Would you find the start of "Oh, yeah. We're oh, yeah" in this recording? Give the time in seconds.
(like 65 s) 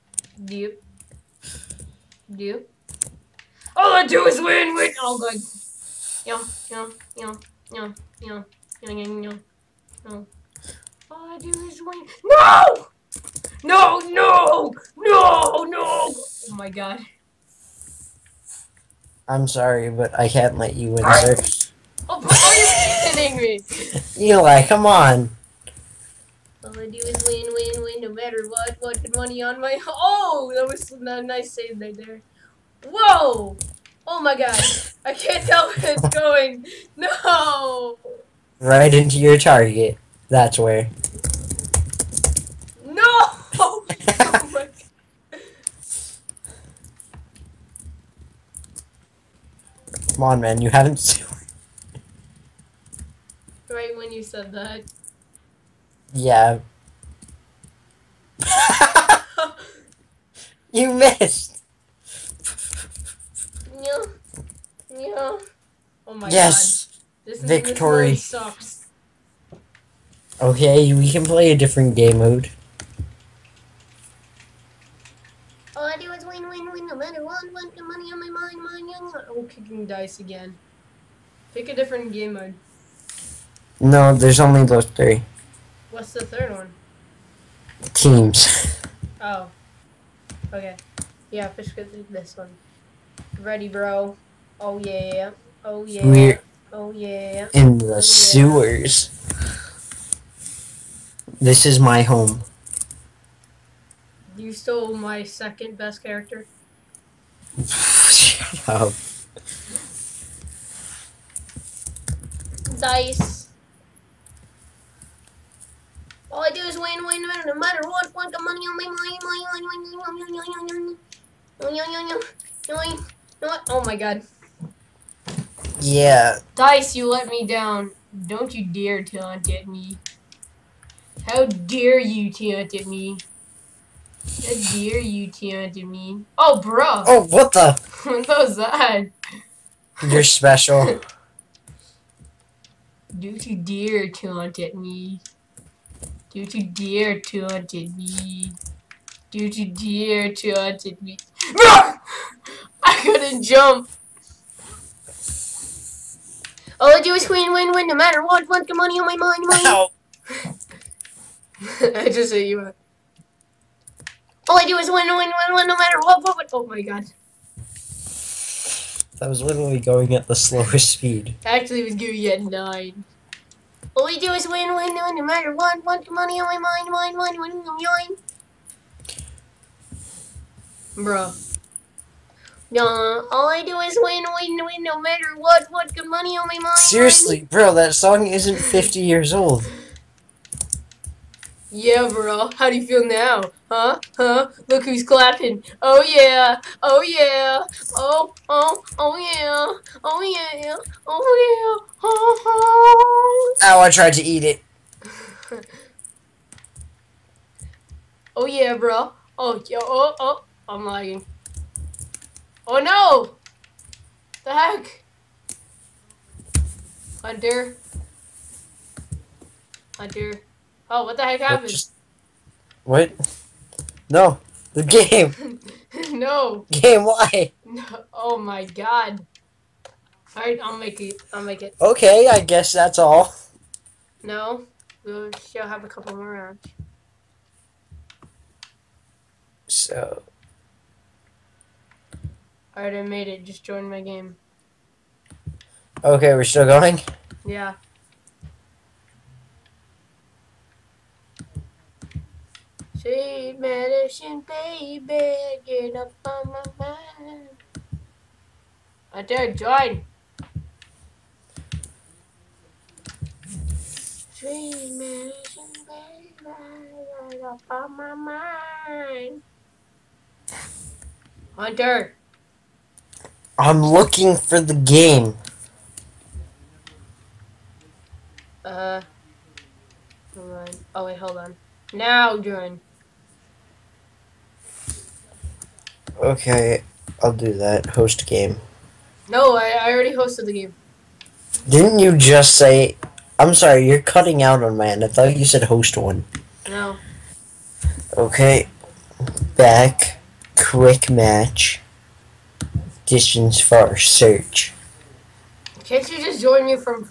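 95 s.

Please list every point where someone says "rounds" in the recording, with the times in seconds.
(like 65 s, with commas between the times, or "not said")
236 s.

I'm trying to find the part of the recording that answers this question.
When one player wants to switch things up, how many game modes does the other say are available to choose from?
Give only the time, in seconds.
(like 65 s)
84 s.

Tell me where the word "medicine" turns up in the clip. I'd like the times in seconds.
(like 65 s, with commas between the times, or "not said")
253 s, 264 s.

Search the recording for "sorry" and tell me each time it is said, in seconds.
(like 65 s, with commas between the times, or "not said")
19 s, 293 s.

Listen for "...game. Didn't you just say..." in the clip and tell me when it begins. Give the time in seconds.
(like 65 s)
290 s.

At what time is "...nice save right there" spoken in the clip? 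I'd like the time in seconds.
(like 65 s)
31 s.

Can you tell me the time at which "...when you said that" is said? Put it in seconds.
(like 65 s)
53 s.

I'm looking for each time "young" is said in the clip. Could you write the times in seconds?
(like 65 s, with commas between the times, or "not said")
78 s.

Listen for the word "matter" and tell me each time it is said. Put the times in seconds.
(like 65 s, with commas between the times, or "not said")
28 s, 76 s, 117 s, 157 s, 165 s, 175 s, 184 s.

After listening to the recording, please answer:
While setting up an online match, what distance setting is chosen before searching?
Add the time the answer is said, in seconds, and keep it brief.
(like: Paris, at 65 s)
far, at 303 s.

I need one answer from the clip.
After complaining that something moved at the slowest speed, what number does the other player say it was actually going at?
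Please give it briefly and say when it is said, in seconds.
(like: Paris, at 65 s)
9, at 172 s.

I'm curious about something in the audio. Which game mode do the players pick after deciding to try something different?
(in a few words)
Teams.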